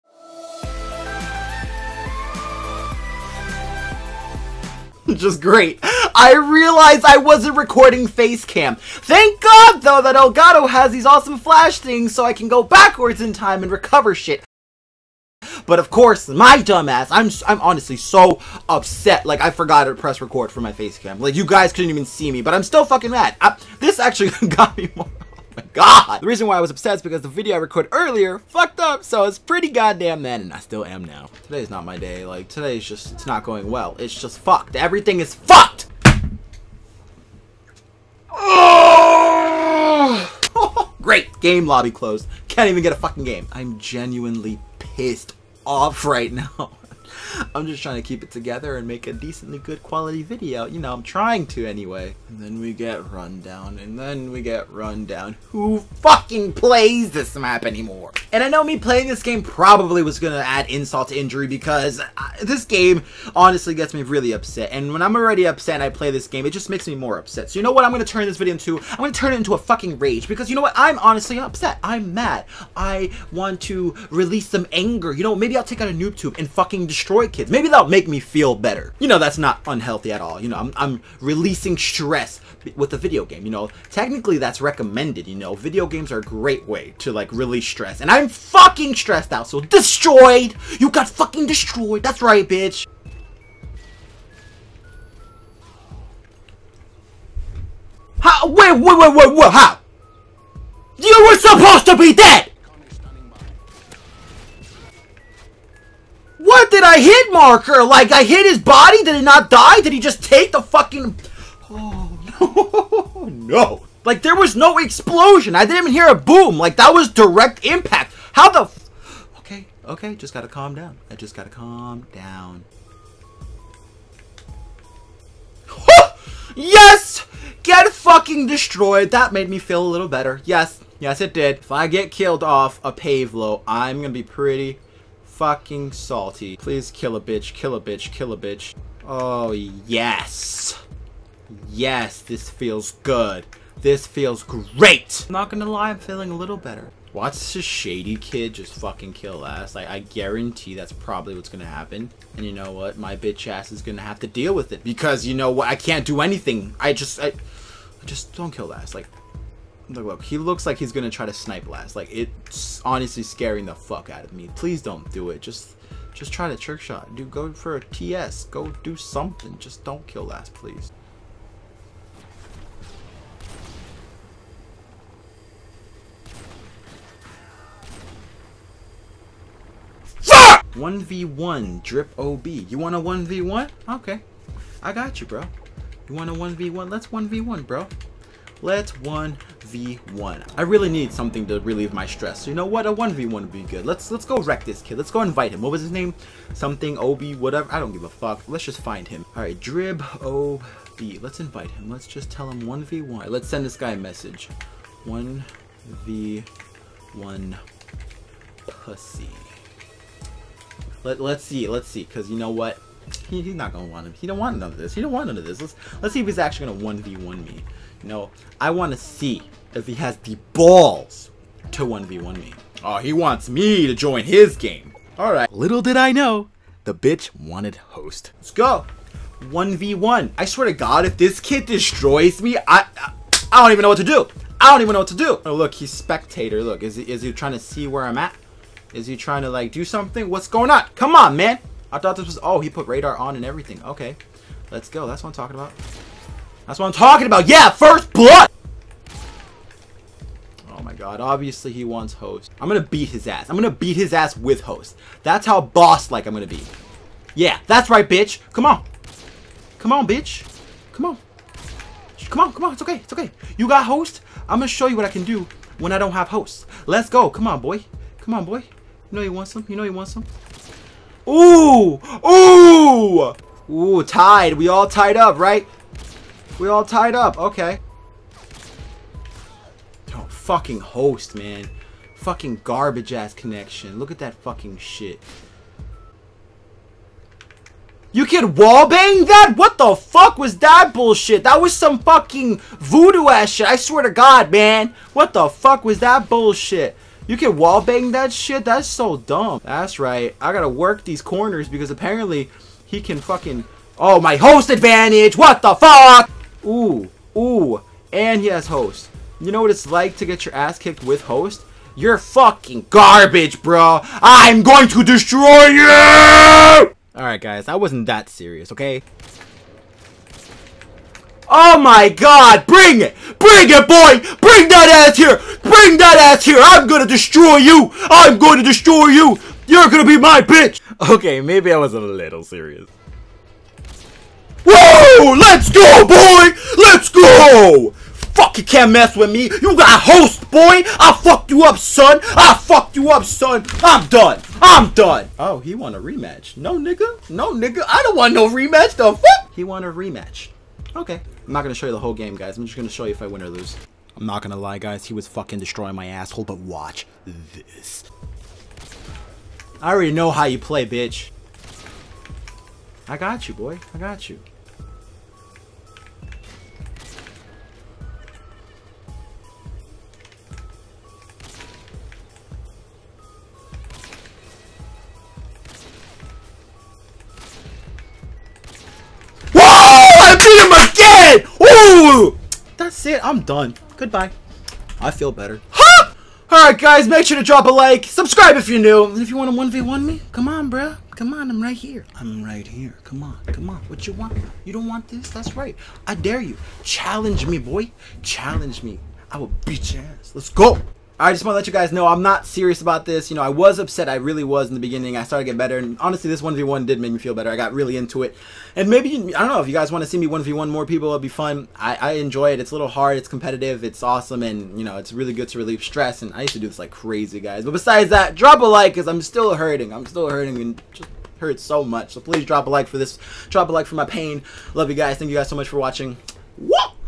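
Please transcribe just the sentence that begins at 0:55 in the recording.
Who fucking plays this map anymore?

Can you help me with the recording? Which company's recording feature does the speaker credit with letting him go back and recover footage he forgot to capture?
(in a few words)
Elgato.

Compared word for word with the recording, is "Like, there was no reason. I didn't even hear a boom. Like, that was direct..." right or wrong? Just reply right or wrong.
wrong.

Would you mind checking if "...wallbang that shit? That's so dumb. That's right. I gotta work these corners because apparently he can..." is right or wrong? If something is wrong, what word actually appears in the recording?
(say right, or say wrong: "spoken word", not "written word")
right.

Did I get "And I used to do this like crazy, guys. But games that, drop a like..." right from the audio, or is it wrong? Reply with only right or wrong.
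wrong.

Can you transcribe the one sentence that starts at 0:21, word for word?
Like, you guys couldn't even see me, but I'm still fucking mad.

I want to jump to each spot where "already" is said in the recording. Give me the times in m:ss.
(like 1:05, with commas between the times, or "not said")
1:05, 5:59.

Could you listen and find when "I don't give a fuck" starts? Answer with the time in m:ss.
3:17.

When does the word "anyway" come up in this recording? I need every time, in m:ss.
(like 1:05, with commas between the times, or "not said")
0:51.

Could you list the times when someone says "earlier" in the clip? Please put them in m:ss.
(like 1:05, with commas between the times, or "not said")
0:27.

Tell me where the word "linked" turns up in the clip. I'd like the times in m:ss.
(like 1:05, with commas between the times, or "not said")
not said.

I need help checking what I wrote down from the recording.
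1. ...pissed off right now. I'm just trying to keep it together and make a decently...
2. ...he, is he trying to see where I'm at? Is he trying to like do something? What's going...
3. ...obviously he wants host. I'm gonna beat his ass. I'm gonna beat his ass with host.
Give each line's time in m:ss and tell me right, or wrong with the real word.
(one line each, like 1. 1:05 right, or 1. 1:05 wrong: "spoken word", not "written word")
1. 0:44 right
2. 3:56 right
3. 4:11 right.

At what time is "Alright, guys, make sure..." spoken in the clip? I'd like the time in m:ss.
6:26.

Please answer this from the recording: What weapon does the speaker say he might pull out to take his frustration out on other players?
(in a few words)
noob tube.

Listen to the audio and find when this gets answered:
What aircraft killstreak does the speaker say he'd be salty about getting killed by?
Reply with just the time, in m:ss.
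2:12.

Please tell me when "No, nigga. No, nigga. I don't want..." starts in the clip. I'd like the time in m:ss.
5:46.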